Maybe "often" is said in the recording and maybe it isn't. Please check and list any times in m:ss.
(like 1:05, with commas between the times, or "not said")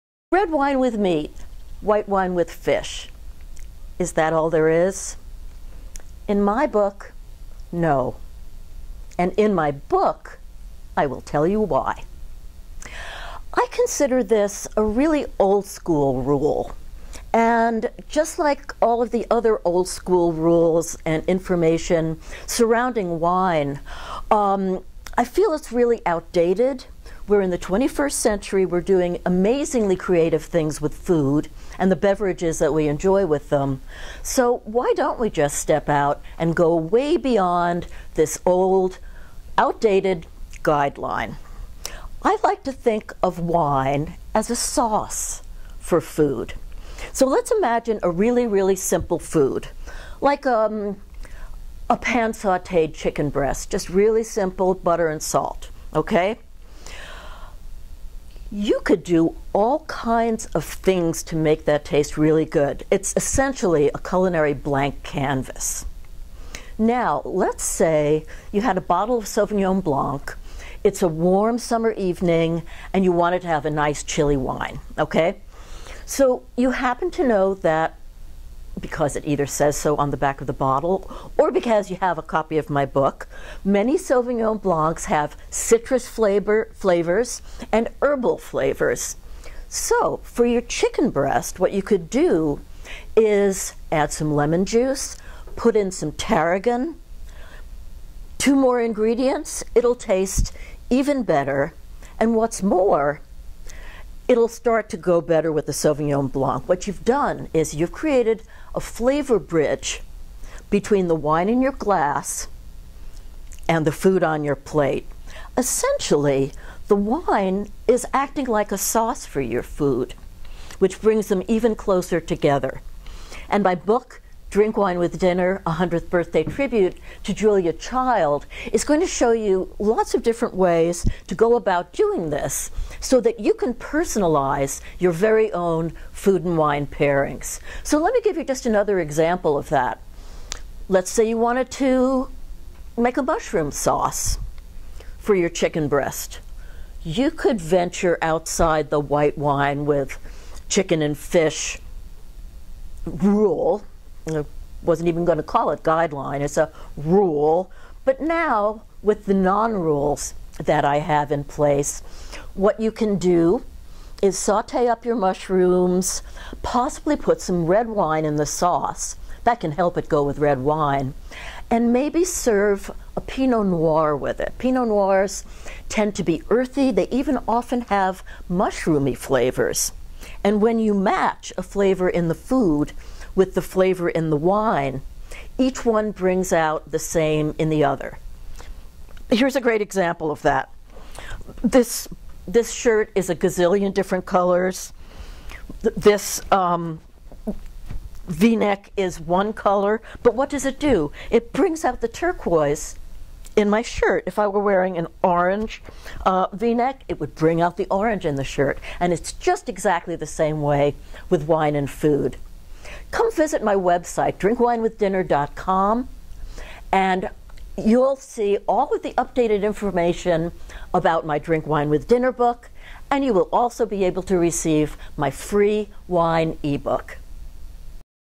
2:57.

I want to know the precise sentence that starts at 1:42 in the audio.
And what's more, it'll start to go better with the Sauvignon Blanc.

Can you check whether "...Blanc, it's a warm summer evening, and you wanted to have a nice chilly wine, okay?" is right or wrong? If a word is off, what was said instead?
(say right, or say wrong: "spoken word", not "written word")
right.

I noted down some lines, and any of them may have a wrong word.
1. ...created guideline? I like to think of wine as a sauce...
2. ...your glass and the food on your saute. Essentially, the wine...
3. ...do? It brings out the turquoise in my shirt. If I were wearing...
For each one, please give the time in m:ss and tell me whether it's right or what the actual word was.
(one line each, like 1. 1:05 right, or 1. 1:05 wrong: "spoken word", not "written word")
1. 0:39 wrong: "outdated", not "created"
2. 1:51 wrong: "plate", not "saute"
3. 3:20 right.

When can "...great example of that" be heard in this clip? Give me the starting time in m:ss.
3:09.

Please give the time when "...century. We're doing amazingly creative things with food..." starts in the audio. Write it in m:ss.
0:28.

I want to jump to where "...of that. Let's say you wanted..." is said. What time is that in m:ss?
2:19.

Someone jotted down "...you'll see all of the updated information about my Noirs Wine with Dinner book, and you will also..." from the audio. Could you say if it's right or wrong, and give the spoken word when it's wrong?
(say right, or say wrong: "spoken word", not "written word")
wrong: "Drink", not "Noirs".